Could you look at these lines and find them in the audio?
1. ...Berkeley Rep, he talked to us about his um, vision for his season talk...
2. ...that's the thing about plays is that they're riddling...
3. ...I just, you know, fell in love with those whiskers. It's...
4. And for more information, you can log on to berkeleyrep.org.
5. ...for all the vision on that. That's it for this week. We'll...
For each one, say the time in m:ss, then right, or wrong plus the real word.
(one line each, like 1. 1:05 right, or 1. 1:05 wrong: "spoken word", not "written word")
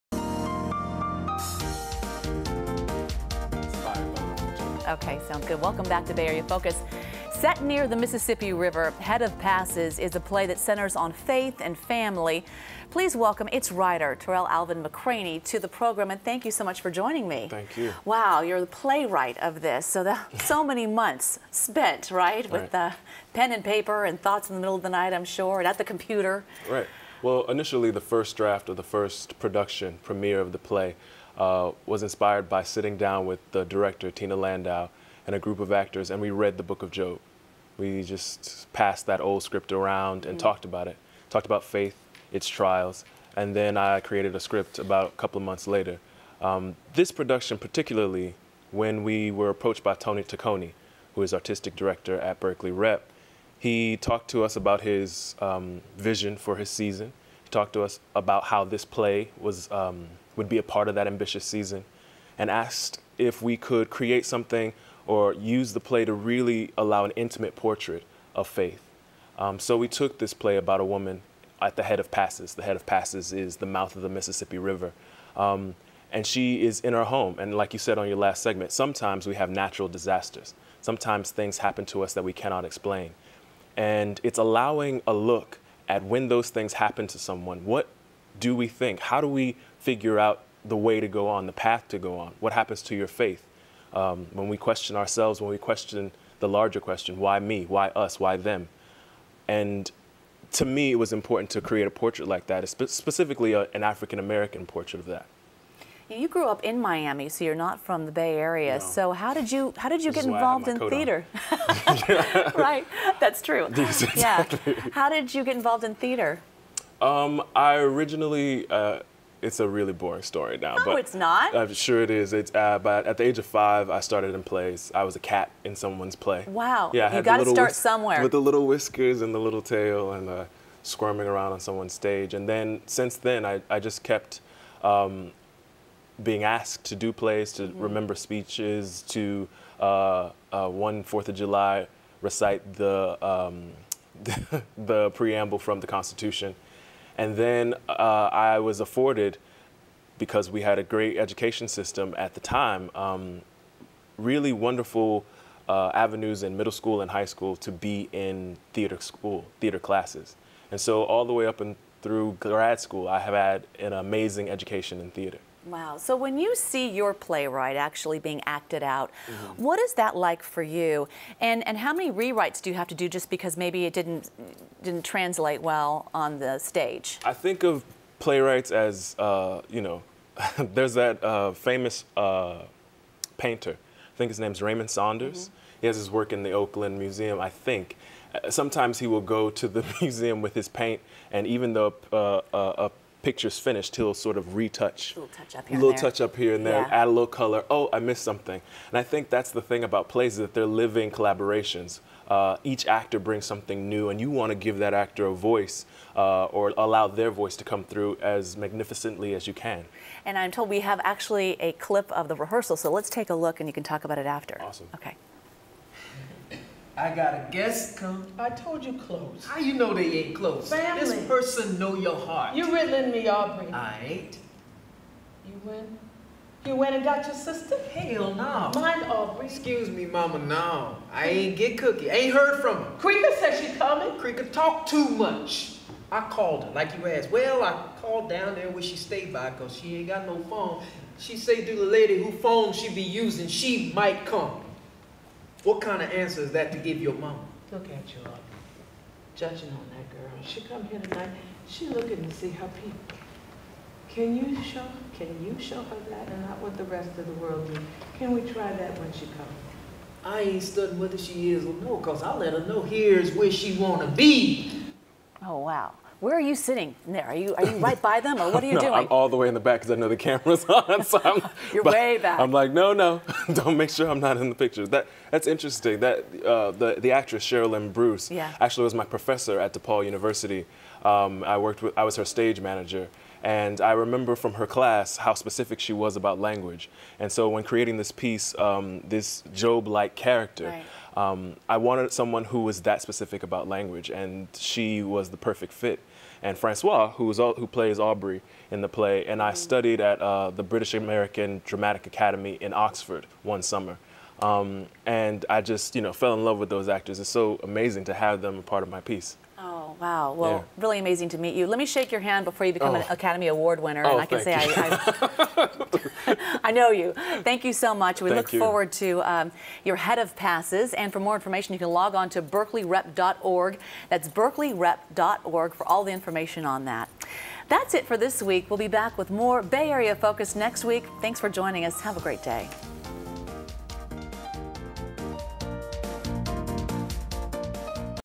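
1. 0:52 right
2. 3:19 wrong: "living", not "riddling"
3. 5:05 wrong: "actors", not "whiskers"
4. 5:20 right
5. 5:25 wrong: "information", not "vision".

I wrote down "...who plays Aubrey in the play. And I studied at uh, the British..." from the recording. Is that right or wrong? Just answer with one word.
right.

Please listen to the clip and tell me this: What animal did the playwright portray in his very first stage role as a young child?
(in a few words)
A cat.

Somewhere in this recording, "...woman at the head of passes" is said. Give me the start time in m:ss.
1:10.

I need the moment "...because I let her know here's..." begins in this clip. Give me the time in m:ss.
4:21.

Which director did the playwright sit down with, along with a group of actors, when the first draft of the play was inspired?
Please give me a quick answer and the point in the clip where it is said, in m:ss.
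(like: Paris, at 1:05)
Tina Landau, at 0:34.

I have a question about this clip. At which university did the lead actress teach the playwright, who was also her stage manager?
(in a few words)
DePaul University.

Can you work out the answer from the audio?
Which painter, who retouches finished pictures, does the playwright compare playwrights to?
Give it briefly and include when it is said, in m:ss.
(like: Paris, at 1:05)
Raymond Saunders, at 3:04.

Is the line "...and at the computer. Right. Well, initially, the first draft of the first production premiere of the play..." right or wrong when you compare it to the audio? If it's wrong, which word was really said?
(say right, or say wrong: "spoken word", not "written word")
right.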